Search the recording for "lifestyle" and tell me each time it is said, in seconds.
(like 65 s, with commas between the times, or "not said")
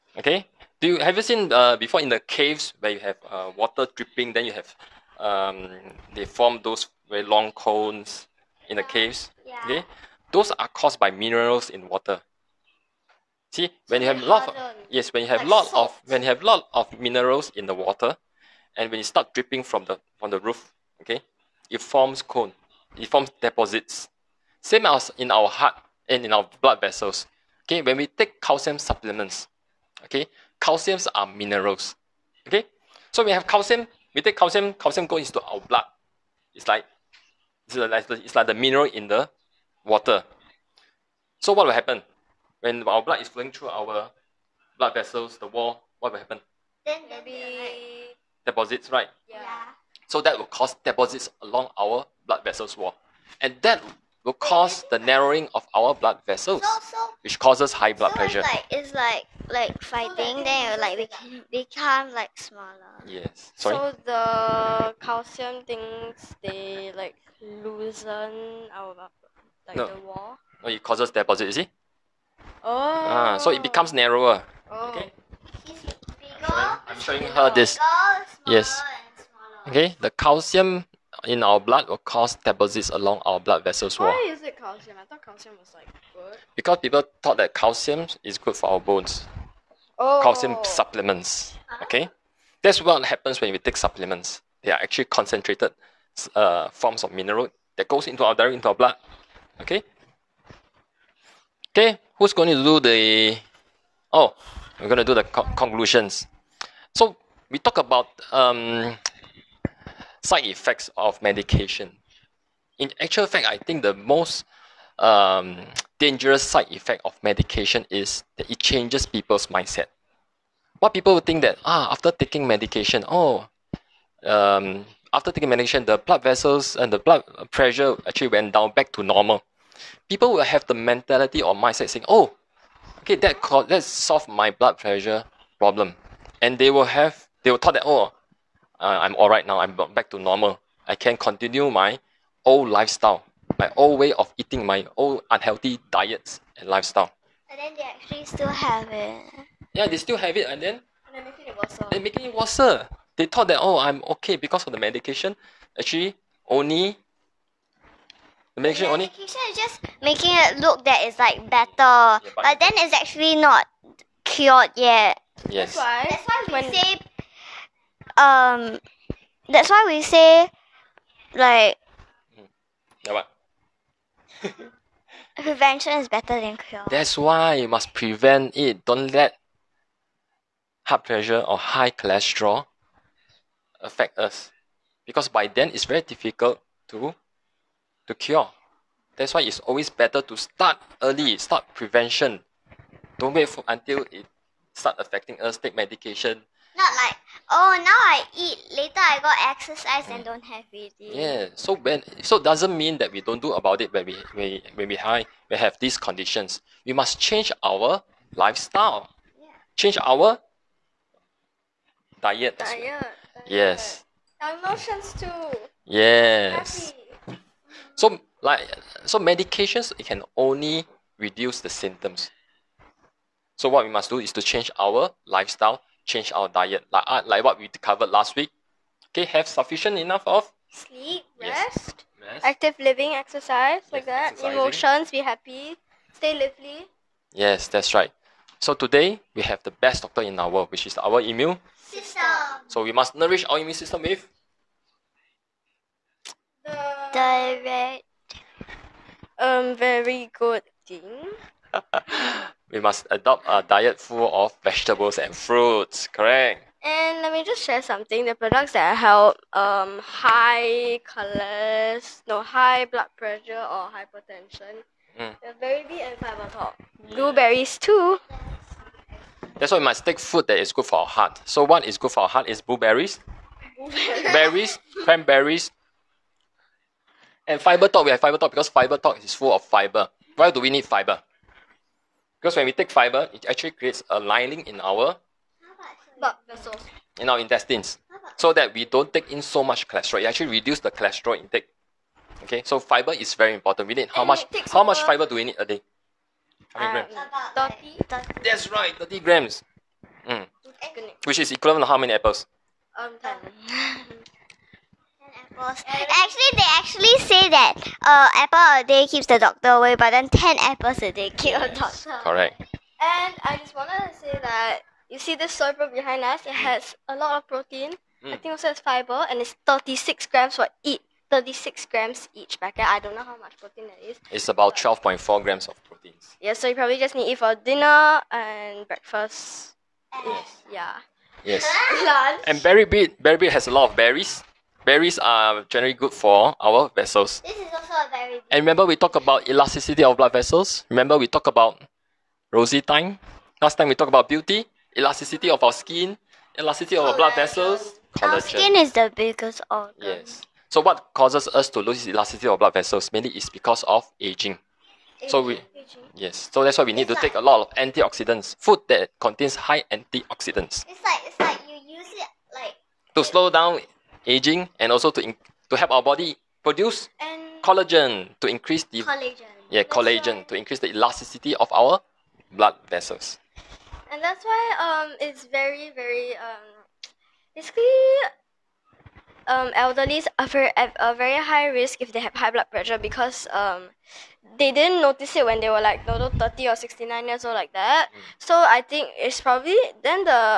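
142 s, 146 s, 208 s, 225 s.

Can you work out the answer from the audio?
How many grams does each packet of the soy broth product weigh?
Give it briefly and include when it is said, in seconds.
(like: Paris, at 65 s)
36 grams, at 321 s.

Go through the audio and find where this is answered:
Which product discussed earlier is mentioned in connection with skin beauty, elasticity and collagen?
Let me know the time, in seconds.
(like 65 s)
342 s.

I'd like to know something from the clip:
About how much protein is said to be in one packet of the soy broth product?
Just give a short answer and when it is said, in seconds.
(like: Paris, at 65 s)
12.4 grams, at 324 s.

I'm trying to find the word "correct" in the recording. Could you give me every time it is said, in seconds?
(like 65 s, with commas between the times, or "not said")
256 s, 312 s.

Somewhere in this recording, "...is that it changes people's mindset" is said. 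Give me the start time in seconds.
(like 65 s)
117 s.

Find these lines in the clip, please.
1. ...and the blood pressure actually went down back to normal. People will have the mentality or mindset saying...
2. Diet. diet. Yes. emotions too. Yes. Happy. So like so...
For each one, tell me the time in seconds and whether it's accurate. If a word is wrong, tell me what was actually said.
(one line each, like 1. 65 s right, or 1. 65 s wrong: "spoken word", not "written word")
1. 126 s right
2. 212 s right.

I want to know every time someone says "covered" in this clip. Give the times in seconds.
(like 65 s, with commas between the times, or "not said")
227 s.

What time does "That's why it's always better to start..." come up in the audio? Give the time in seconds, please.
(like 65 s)
189 s.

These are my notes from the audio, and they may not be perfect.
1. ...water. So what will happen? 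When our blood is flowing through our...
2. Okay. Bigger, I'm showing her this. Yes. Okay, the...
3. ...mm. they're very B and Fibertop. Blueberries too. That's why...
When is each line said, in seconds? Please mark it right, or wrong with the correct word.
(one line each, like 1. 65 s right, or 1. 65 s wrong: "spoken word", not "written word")
1. 39 s right
2. 74 s right
3. 265 s right.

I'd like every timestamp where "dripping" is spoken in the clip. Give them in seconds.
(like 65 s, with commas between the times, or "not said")
3 s, 19 s.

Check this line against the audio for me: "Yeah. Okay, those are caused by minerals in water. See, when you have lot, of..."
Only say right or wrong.
right.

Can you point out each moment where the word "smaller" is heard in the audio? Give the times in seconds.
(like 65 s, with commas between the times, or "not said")
62 s.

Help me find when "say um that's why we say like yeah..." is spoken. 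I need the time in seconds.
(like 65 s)
166 s.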